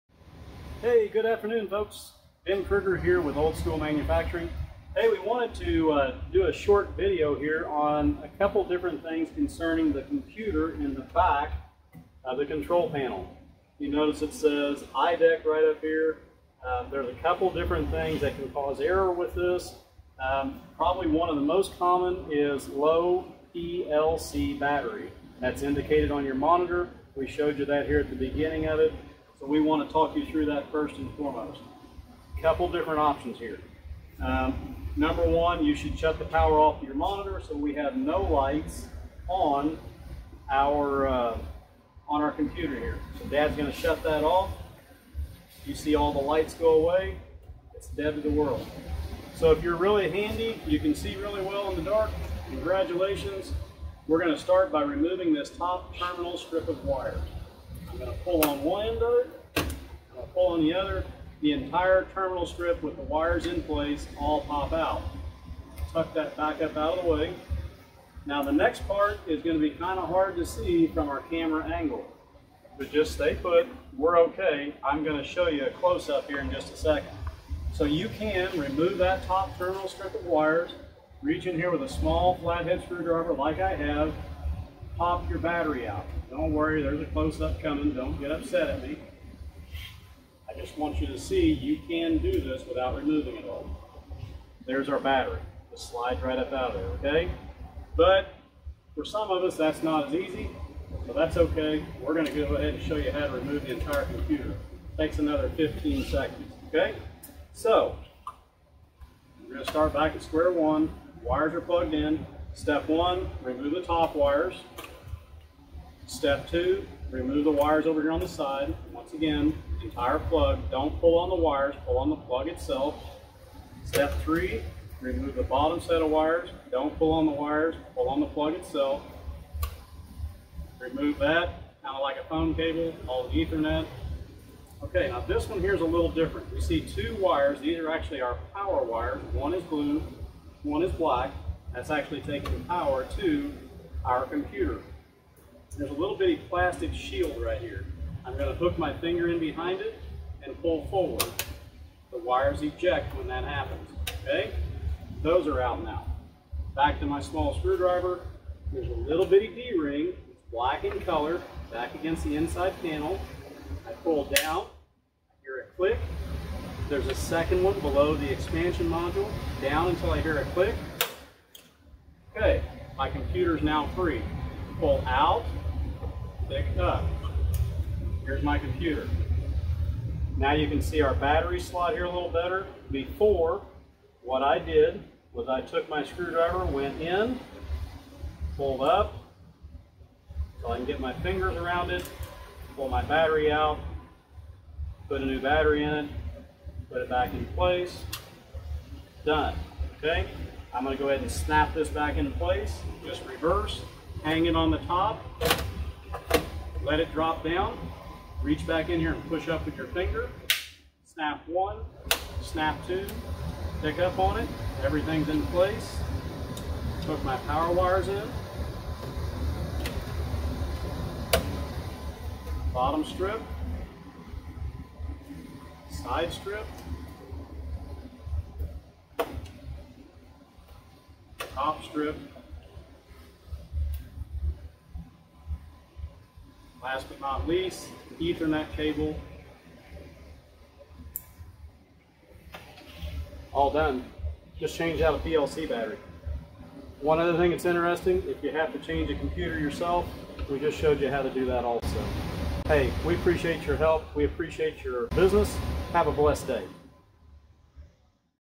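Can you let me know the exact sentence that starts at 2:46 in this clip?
There's a second one below the expansion module, down until I hear a click.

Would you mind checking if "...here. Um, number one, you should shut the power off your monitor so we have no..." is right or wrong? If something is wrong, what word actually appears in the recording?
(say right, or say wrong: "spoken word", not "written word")
right.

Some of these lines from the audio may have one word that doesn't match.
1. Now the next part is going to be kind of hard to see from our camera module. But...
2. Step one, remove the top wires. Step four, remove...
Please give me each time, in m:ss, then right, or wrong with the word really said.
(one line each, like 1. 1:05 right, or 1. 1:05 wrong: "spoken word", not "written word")
1. 1:08 wrong: "angle", not "module"
2. 1:52 wrong: "two", not "four".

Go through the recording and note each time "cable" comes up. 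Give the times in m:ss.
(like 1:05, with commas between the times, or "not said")
2:12, 3:58.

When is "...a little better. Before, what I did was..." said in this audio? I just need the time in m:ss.
3:02.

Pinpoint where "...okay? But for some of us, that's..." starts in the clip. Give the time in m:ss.
1:37.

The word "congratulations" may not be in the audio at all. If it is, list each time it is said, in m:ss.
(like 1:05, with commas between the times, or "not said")
0:52.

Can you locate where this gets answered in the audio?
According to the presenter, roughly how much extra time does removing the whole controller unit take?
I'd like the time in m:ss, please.
1:45.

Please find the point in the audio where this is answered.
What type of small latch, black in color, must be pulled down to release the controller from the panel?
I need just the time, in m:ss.
2:39.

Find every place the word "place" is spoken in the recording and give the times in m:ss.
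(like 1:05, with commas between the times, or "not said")
1:03, 3:17, 3:22, 3:35.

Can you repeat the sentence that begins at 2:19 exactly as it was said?
One is blue, one is black.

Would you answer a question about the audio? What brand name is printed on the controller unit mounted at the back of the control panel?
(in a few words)
IDEC.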